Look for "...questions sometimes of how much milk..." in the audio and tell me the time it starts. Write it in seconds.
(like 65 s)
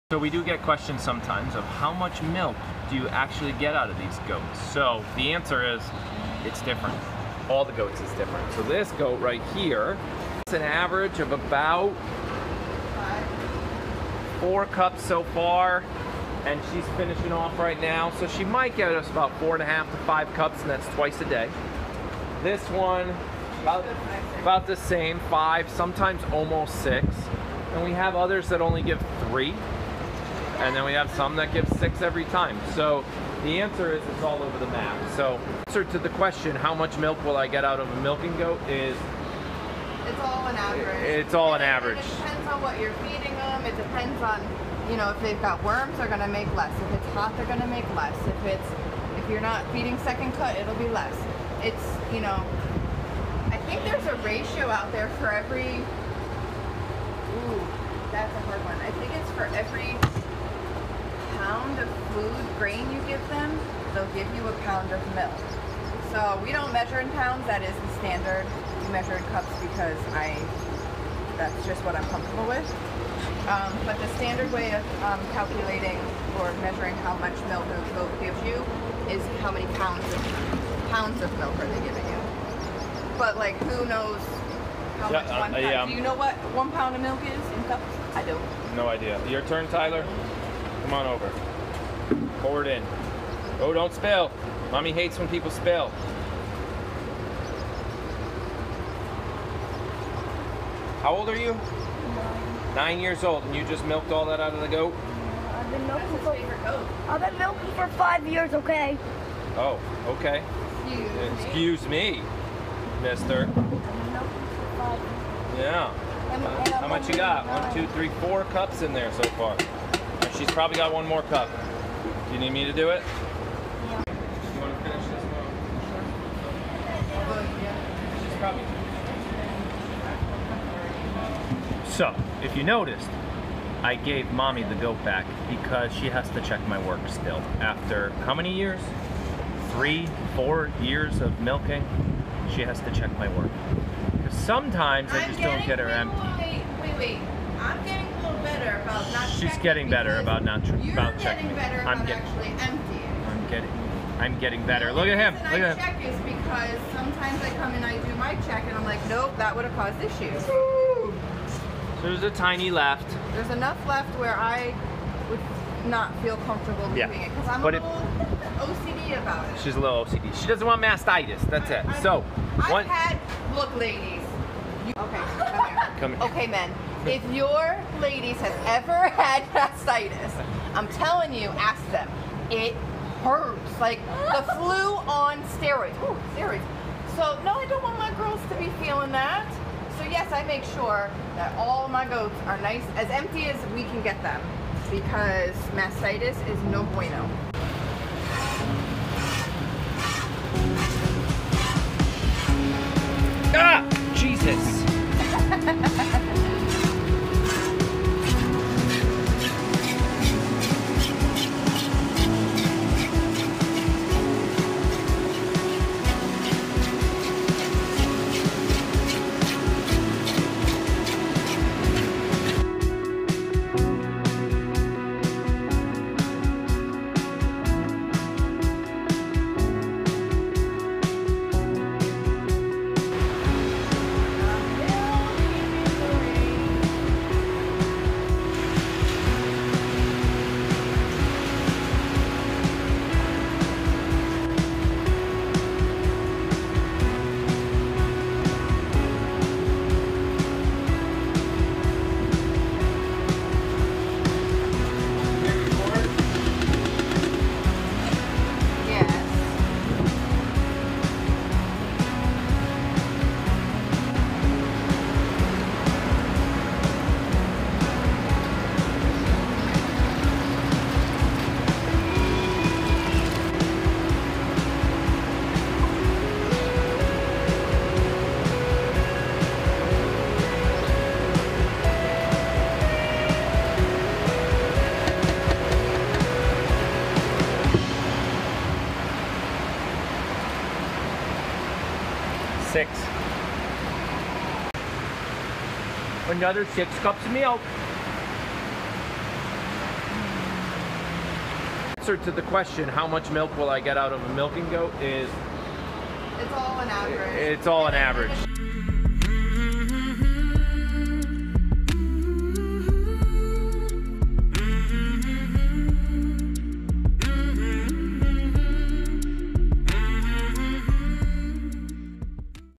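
0 s.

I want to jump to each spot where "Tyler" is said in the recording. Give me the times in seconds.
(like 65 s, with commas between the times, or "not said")
89 s.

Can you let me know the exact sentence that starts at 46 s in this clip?
If it's hot, they're gonna make less.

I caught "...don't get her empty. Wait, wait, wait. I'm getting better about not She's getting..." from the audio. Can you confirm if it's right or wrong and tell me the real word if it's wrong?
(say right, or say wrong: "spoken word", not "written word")
right.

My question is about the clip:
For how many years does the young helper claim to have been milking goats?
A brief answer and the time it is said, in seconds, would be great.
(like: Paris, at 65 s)
5 years, at 107 s.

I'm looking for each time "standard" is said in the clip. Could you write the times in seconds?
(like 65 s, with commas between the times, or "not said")
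67 s, 74 s.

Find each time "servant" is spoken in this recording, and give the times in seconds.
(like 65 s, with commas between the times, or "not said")
not said.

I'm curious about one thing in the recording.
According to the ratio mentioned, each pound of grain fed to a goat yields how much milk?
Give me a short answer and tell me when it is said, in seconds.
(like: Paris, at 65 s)
1 pound, at 64 s.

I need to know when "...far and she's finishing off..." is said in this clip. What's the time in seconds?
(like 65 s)
15 s.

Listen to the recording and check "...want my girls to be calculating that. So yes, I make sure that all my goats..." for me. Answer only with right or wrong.
wrong.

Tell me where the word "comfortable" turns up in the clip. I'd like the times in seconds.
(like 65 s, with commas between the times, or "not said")
72 s, 166 s.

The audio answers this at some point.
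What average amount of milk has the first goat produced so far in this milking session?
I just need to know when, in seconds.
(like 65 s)
11 s.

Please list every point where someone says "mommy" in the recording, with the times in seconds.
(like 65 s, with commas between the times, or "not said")
94 s, 134 s.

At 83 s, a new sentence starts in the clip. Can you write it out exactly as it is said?
But like, who knows how yeah, much one pound?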